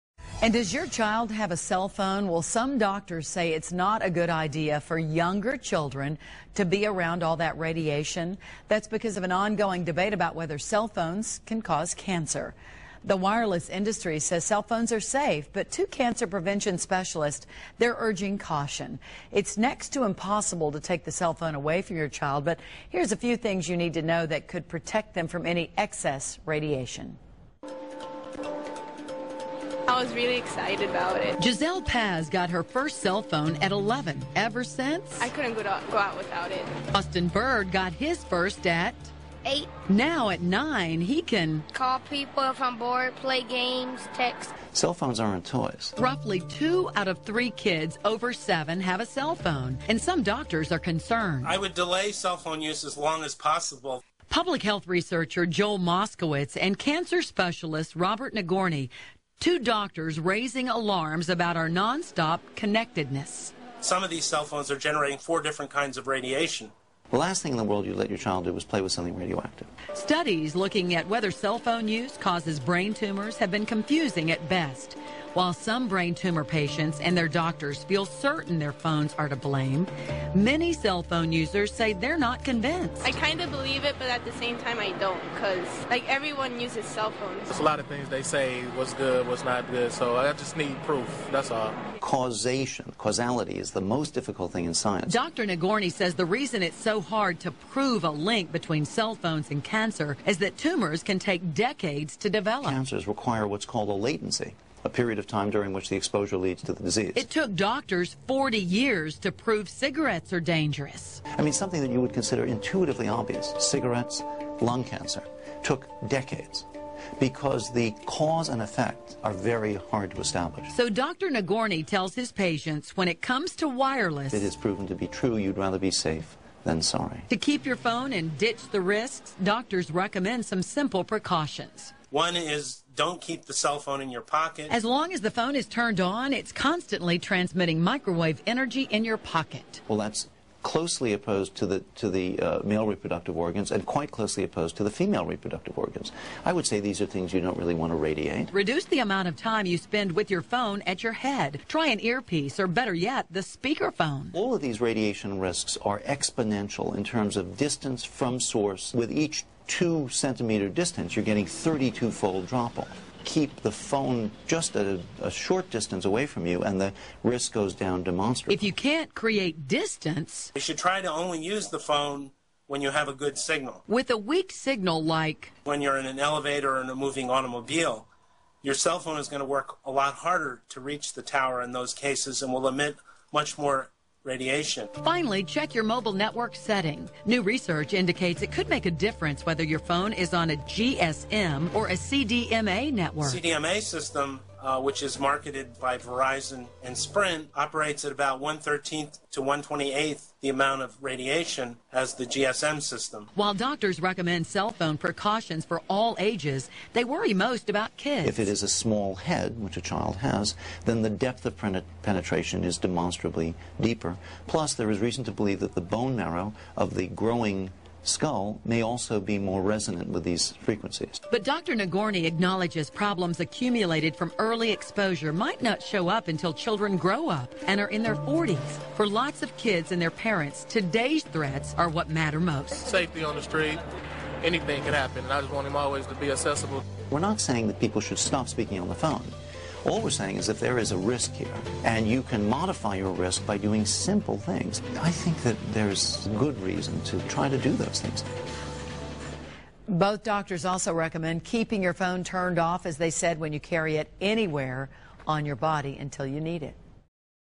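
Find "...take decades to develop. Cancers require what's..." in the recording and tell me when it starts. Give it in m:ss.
1:41.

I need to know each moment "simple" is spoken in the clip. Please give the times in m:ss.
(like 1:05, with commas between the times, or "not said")
2:10, 4:03.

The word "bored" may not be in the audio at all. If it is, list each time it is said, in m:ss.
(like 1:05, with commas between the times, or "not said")
0:42.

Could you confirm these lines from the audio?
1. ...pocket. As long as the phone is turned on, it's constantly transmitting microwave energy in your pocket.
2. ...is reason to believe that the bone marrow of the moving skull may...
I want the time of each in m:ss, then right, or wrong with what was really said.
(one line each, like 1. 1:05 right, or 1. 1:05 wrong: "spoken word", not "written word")
1. 2:14 right
2. 3:34 wrong: "growing", not "moving".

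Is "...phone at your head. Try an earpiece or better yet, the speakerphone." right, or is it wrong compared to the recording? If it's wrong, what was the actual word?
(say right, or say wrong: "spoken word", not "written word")
right.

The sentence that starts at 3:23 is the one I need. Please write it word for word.
While doctors recommend cell phone precautions for all ages, they worry most about kids.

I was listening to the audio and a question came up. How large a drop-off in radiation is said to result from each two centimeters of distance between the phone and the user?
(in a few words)
32-fold.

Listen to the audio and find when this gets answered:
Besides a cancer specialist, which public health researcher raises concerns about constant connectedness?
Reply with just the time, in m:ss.
0:55.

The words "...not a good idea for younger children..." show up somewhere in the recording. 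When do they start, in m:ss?
0:03.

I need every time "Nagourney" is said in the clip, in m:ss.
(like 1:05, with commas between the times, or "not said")
0:58, 1:35, 2:01, 3:41.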